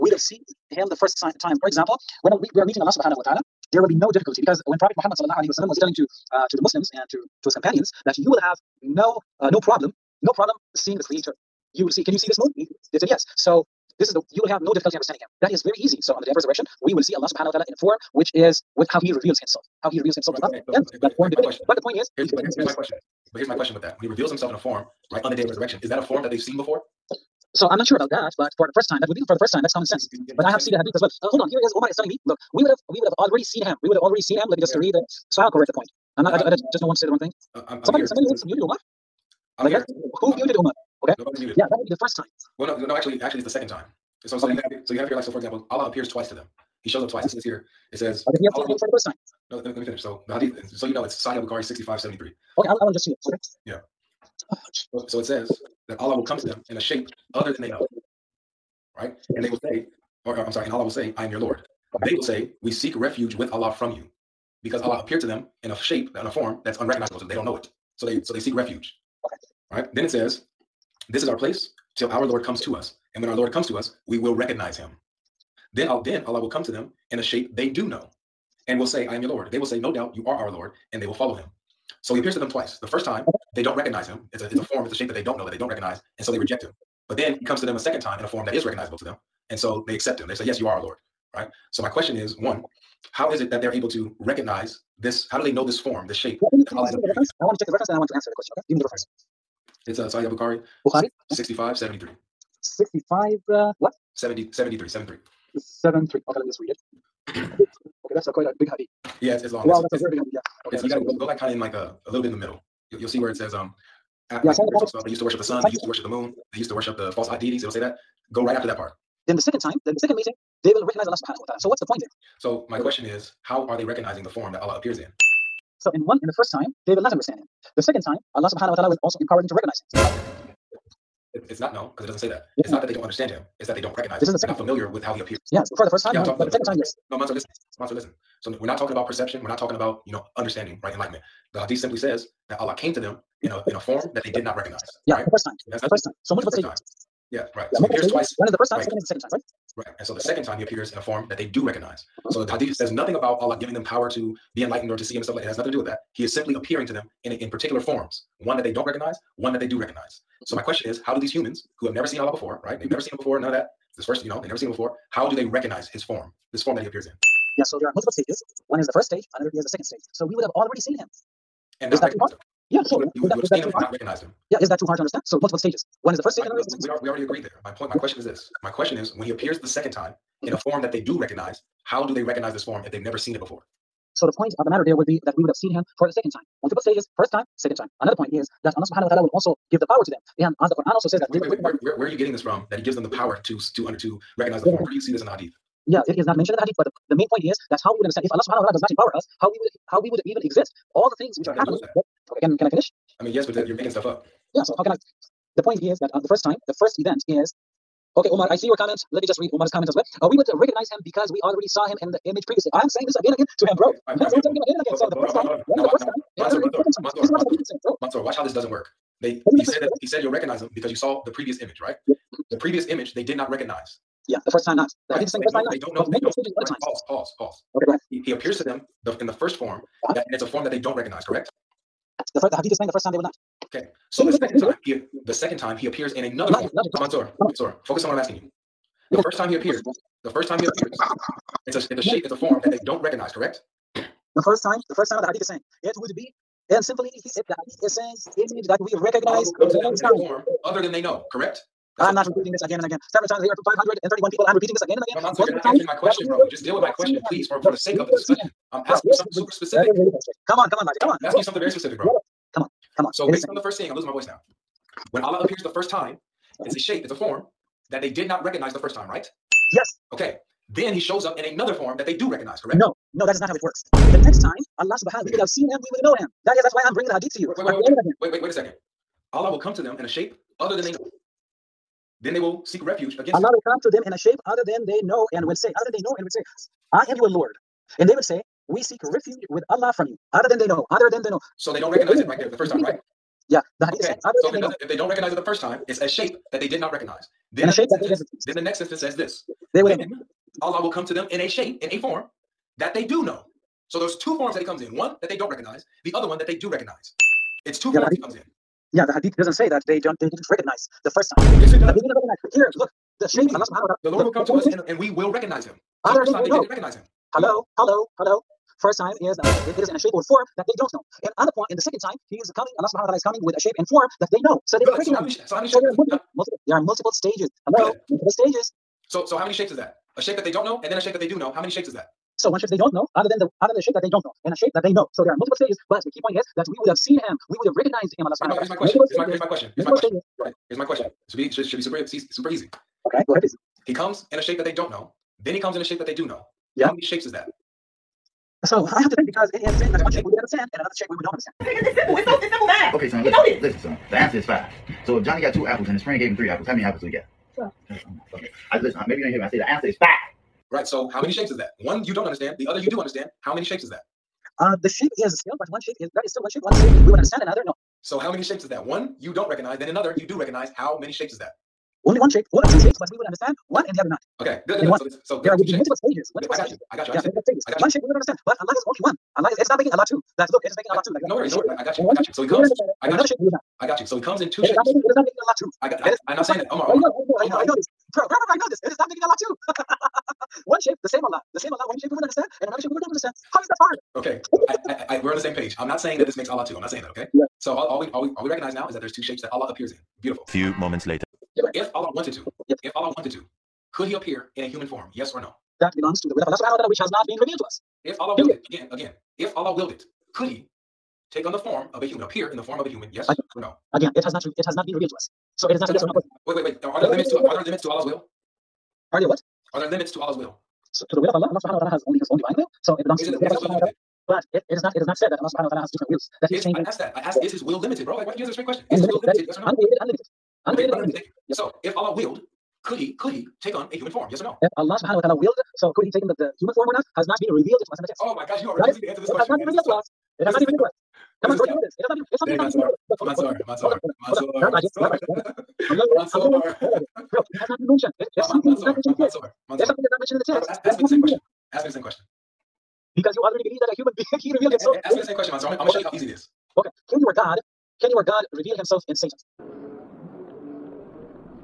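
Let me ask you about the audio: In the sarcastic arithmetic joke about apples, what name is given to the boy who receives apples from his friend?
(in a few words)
Johnny.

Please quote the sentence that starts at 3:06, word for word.
Multiple stages, first time, second time.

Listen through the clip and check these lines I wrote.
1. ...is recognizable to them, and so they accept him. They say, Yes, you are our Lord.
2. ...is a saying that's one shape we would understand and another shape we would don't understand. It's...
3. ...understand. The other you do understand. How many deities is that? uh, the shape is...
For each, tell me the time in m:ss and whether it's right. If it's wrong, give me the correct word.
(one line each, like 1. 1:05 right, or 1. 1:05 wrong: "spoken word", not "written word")
1. 1:28 right
2. 5:49 right
3. 6:02 wrong: "shapes", not "deities".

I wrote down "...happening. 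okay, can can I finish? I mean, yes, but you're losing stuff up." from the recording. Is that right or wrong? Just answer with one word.
wrong.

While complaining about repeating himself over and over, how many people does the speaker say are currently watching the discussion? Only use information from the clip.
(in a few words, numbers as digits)
531.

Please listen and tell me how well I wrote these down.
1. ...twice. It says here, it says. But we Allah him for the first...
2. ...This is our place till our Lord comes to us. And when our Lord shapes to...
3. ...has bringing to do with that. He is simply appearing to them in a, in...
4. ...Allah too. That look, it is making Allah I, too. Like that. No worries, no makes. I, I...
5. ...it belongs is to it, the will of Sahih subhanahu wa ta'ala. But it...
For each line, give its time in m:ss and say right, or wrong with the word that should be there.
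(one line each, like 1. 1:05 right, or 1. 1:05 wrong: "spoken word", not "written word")
1. 0:47 right
2. 1:11 wrong: "comes", not "shapes"
3. 2:35 wrong: "nothing", not "bringing"
4. 6:19 wrong: "worries", not "makes"
5. 7:02 wrong: "Allah", not "Sahih".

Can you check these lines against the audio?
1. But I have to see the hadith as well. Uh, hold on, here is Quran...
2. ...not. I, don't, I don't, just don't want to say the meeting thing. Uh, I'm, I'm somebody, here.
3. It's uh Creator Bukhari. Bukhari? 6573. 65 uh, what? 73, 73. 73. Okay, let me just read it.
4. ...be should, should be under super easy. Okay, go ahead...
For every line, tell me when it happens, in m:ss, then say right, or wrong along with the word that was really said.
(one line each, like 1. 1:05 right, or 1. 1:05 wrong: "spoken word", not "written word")
1. 0:30 wrong: "Omar", not "Quran"
2. 0:36 wrong: "wrong", not "meeting"
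3. 1:39 wrong: "Sahih", not "Creator"
4. 5:41 wrong: "super", not "under".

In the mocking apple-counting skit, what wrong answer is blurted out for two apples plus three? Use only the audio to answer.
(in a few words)
12.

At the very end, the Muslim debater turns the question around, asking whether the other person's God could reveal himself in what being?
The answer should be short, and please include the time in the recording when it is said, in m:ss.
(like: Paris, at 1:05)
Satan, at 7:39.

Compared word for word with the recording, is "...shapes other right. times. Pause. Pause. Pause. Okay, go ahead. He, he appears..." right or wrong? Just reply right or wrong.
wrong.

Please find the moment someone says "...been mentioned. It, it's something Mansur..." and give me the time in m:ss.
7:27.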